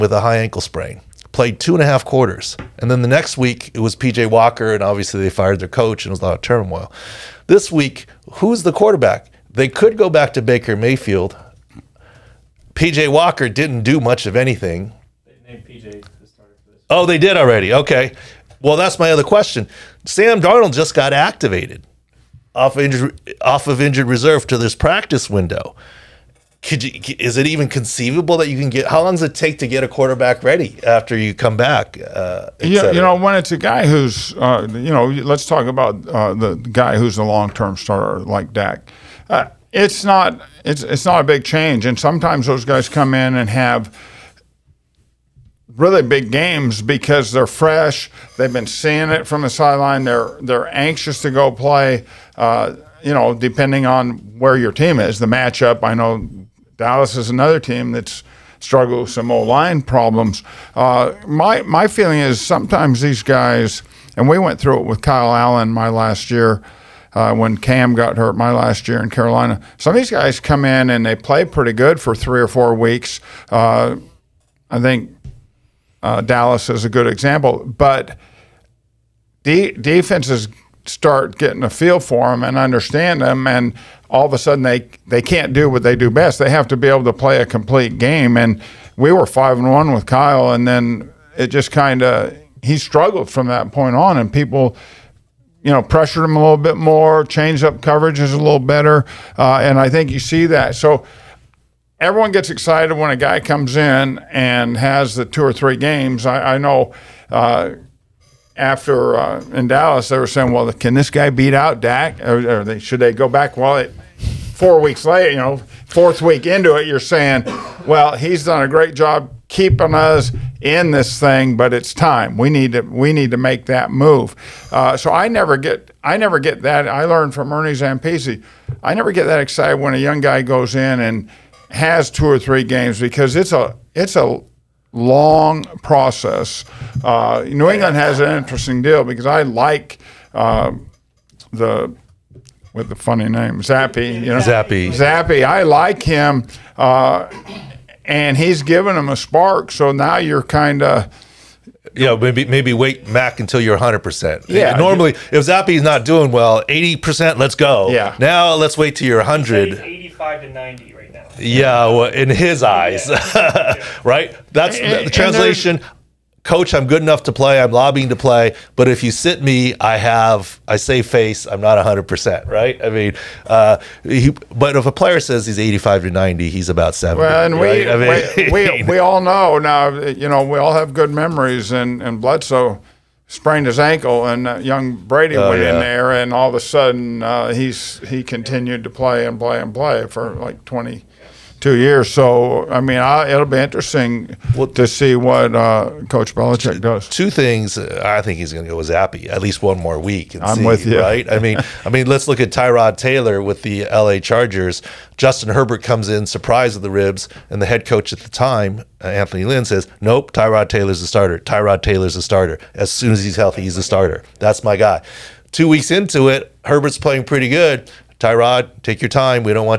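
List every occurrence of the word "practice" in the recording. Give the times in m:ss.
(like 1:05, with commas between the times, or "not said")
0:24.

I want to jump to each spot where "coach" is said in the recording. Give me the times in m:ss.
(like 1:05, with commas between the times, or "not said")
0:05, 2:46, 3:16, 3:27.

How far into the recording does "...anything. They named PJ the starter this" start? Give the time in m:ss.
0:14.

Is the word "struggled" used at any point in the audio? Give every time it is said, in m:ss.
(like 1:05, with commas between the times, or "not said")
0:58, 1:32.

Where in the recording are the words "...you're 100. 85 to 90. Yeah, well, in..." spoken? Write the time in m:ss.
2:39.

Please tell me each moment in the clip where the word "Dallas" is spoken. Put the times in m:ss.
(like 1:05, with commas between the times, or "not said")
0:56, 1:16, 1:49.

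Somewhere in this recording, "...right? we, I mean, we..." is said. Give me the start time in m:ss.
2:57.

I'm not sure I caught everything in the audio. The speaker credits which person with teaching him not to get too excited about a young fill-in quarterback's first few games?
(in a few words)
Ernie Zampese.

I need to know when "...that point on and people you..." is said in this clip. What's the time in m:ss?
1:33.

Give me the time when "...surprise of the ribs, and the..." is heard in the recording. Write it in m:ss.
3:26.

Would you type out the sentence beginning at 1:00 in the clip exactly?
Uh, my my feeling is sometimes these guys, and we went through it with Kyle Allen my last year.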